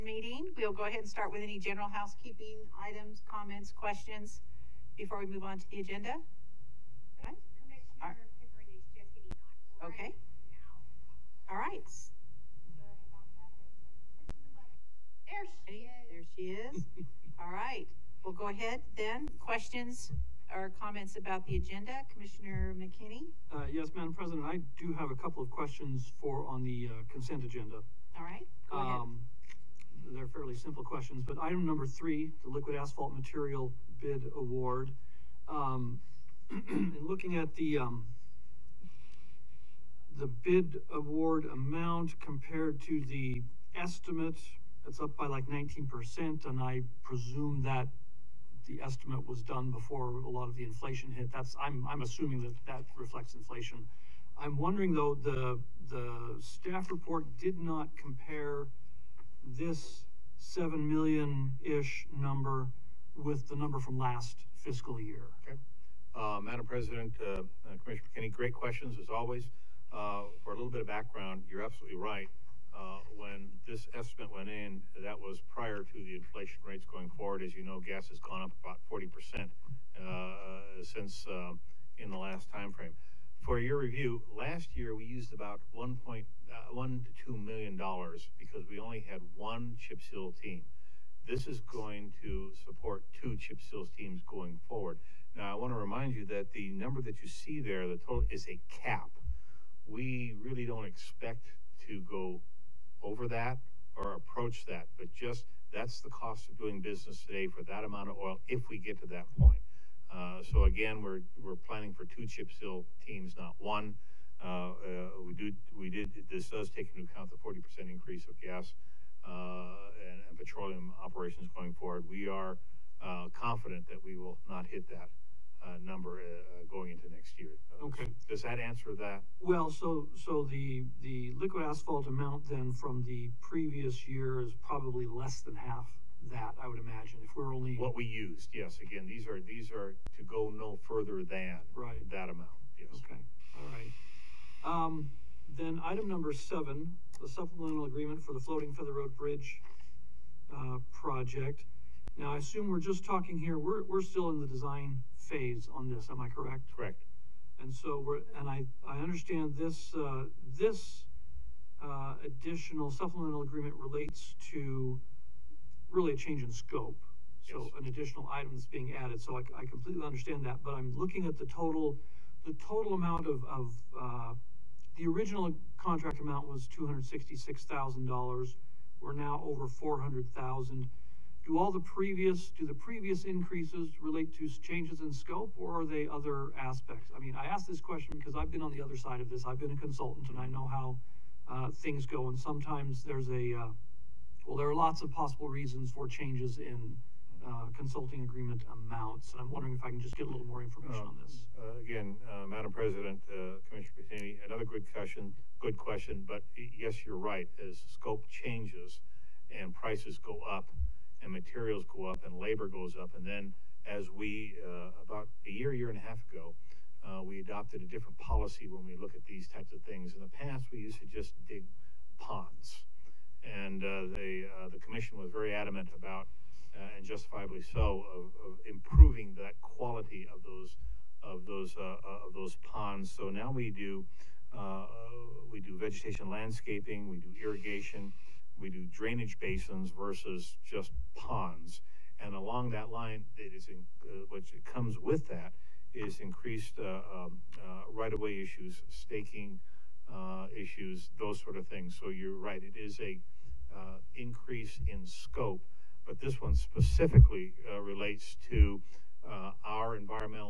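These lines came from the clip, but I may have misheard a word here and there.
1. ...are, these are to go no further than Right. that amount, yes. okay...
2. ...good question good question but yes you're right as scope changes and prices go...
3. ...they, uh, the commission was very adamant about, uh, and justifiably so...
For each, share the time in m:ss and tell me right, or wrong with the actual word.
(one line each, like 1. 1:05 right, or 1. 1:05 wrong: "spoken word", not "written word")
1. 2:19 right
2. 3:24 right
3. 3:44 right.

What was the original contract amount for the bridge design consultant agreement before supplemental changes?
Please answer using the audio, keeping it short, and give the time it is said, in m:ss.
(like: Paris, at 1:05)
$266,000, at 2:56.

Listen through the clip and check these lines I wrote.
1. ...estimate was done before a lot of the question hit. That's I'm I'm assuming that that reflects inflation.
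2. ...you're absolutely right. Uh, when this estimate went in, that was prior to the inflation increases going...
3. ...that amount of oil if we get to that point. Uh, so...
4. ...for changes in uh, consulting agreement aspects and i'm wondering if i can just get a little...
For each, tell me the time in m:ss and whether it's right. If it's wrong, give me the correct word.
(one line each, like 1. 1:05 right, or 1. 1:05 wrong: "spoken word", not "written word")
1. 0:48 wrong: "inflation", not "question"
2. 1:11 wrong: "rates", not "increases"
3. 1:47 right
4. 3:15 wrong: "amounts", not "aspects".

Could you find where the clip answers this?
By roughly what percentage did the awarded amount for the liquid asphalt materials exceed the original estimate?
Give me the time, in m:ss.
0:45.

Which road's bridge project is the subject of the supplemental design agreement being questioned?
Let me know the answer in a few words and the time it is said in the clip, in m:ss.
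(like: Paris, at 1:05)
Floating Feather Road, at 2:28.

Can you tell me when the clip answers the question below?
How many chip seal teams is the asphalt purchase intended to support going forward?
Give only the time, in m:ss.
1:33.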